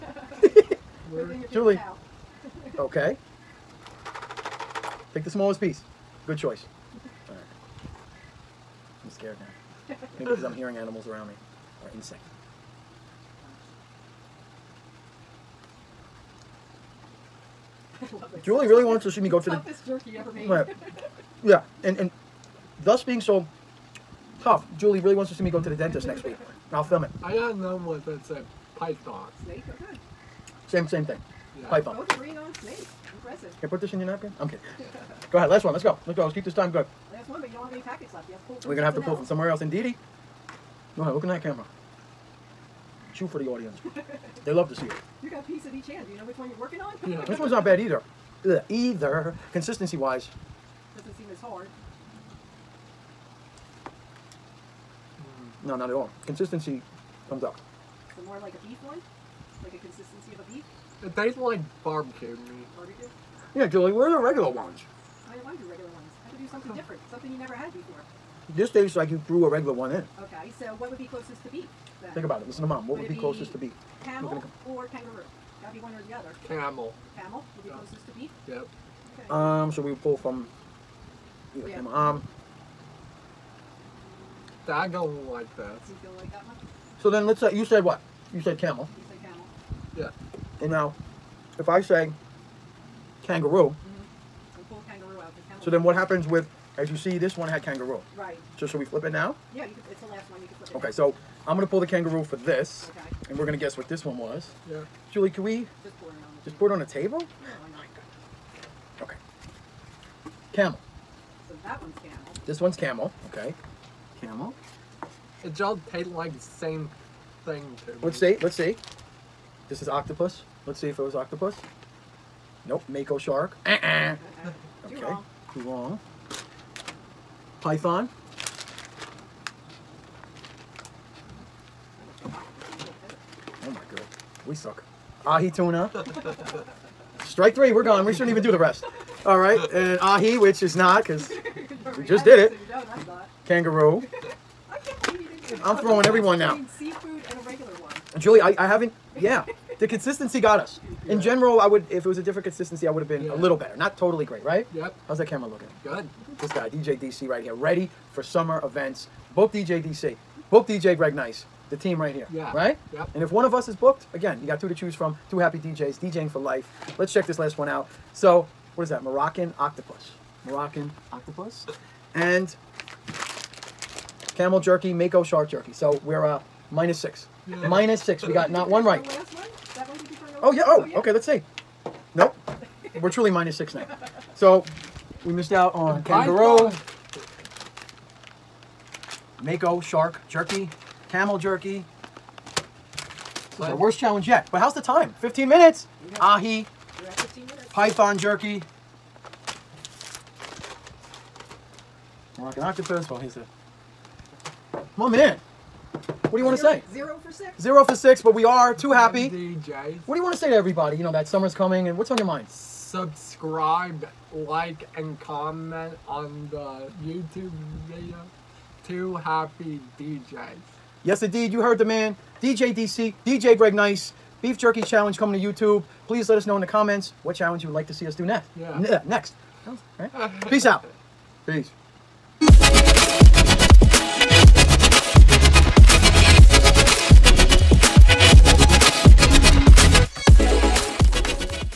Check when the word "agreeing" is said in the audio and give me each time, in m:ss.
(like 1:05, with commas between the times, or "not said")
0:32.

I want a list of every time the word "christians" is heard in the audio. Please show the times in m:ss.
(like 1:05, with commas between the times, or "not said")
not said.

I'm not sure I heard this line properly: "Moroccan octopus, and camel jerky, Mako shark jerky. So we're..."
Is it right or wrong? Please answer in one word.
right.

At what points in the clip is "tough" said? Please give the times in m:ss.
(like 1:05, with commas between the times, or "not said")
0:24.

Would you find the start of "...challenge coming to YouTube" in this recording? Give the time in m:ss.
3:44.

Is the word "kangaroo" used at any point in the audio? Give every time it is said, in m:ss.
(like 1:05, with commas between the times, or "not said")
1:14, 1:33, 1:37, 1:41, 2:23, 3:06.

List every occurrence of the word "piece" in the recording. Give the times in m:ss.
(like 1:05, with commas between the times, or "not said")
0:05, 0:45.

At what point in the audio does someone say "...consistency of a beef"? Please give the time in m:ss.
0:59.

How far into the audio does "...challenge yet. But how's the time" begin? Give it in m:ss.
3:13.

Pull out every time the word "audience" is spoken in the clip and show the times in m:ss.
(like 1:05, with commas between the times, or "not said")
0:43.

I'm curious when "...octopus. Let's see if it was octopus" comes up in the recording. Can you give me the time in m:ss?
1:59.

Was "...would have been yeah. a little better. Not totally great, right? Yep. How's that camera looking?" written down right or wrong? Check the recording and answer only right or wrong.
right.